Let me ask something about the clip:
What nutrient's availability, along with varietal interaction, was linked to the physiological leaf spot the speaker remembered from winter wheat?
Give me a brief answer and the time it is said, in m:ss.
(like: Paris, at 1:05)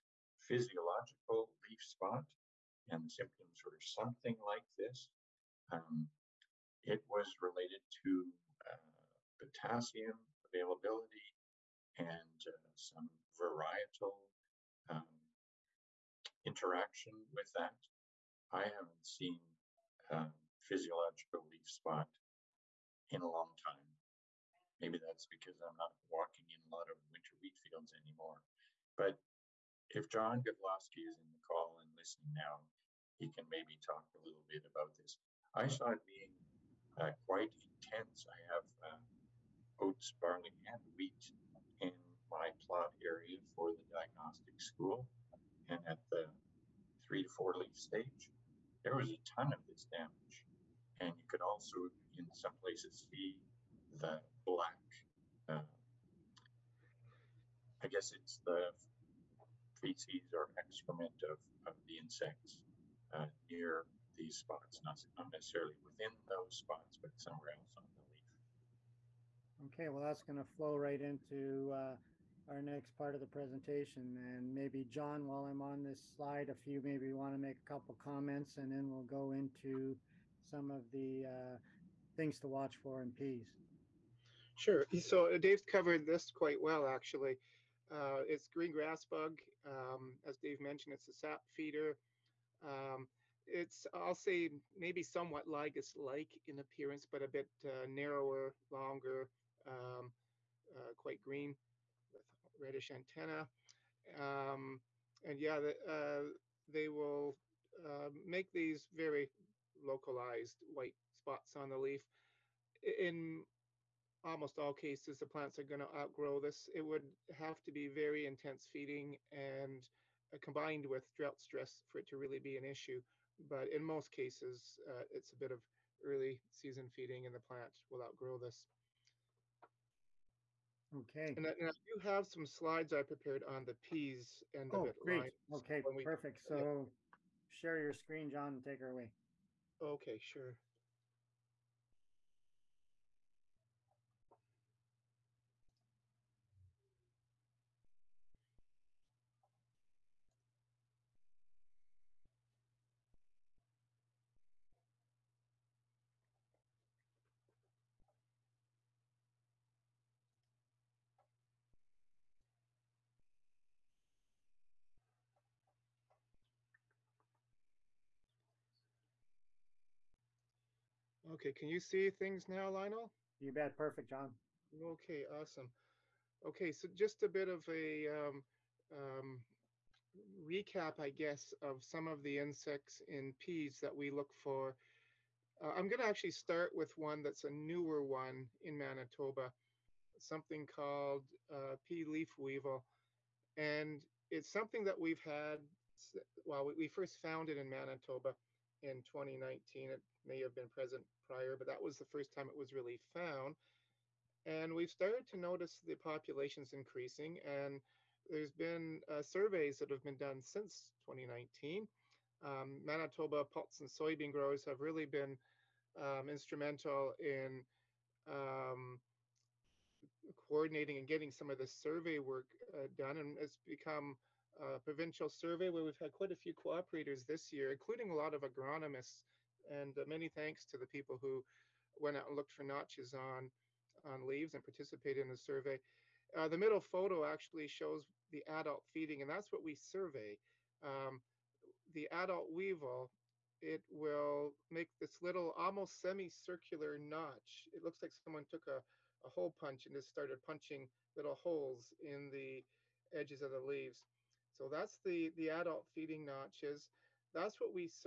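Potassium, at 0:09.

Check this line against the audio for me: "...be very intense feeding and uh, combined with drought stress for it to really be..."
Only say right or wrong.
right.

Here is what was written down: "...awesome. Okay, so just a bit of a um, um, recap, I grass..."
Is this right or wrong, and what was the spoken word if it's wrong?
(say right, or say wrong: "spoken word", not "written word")
wrong: "guess", not "grass".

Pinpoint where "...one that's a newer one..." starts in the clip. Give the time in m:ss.
3:06.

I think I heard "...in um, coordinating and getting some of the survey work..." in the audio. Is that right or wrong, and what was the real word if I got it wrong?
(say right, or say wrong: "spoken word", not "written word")
right.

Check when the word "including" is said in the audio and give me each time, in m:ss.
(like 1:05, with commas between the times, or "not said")
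3:47.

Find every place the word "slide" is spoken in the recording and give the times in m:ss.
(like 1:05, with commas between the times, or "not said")
1:16, 2:12.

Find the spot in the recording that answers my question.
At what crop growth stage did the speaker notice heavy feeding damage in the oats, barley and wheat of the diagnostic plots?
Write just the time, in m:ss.
0:47.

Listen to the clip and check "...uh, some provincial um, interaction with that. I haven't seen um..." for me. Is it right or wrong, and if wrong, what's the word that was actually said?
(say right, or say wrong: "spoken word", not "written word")
wrong: "varietal", not "provincial".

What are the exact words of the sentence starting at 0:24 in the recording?
Maybe that's because I'm not walking in a lot of winter wheat fields anymore.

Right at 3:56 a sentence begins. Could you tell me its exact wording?
Uh, the middle photo actually shows the adult feeding, and that's what we survey.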